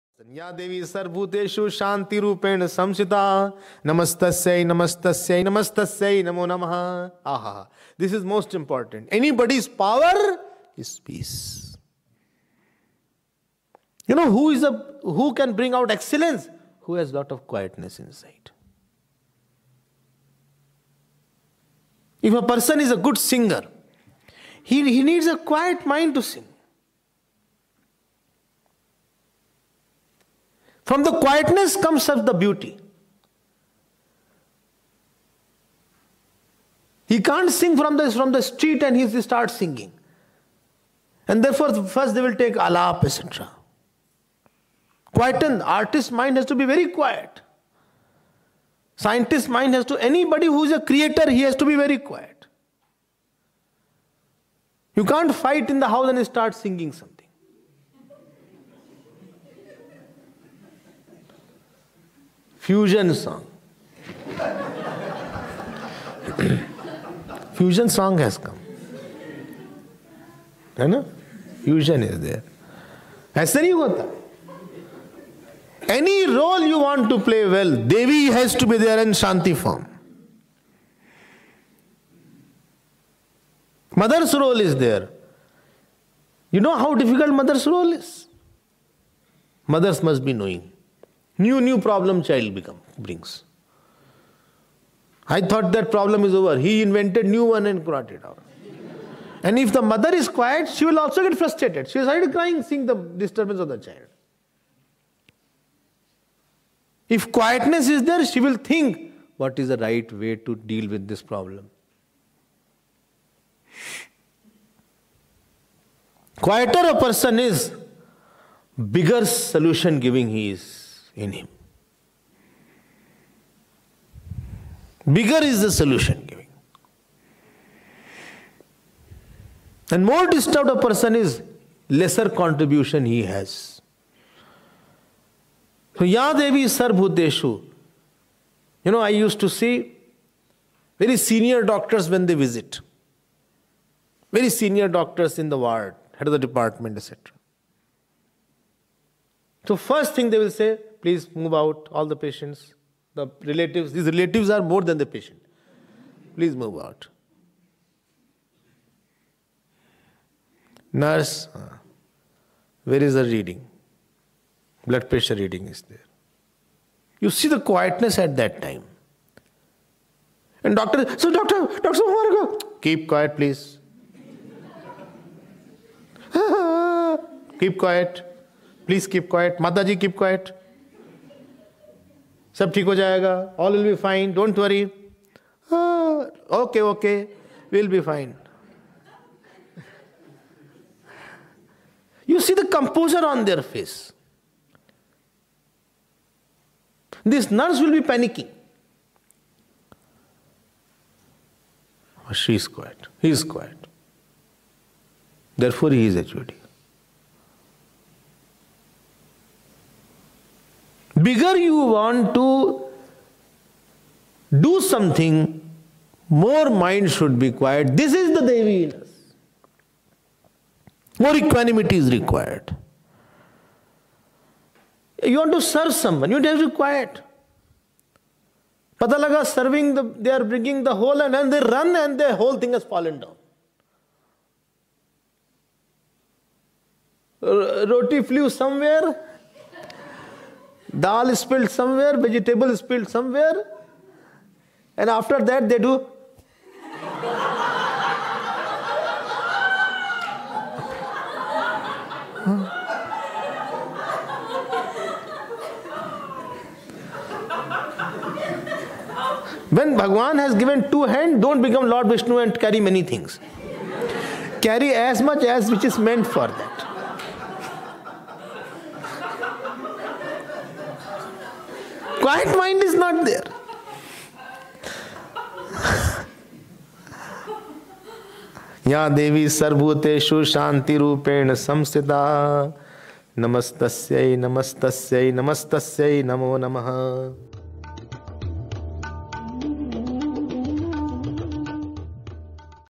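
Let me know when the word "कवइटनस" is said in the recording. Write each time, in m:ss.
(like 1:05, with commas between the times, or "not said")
0:17.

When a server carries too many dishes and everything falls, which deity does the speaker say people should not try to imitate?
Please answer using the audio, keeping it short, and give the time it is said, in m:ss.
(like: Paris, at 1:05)
Lord Vishnu, at 4:21.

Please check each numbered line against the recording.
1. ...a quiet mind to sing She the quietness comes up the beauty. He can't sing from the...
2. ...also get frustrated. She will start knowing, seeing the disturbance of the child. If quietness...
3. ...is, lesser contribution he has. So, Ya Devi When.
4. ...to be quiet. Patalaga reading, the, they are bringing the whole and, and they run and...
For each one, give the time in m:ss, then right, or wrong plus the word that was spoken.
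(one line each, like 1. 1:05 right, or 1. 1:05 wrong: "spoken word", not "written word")
1. 0:25 wrong: "From", not "She"
2. 1:41 wrong: "crying", not "knowing"
3. 2:11 wrong: "Sarvbhuteshu", not "When"
4. 3:46 wrong: "serving", not "reading".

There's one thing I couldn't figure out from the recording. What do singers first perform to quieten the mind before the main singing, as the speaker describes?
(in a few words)
alap.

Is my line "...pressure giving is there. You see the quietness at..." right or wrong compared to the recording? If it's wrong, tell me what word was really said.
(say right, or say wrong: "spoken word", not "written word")
wrong: "reading", not "giving".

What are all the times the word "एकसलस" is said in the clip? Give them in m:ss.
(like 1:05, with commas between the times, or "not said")
0:15.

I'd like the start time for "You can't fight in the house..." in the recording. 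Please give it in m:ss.
0:54.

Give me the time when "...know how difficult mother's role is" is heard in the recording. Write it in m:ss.
1:26.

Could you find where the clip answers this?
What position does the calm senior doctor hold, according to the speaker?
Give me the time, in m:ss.
3:26.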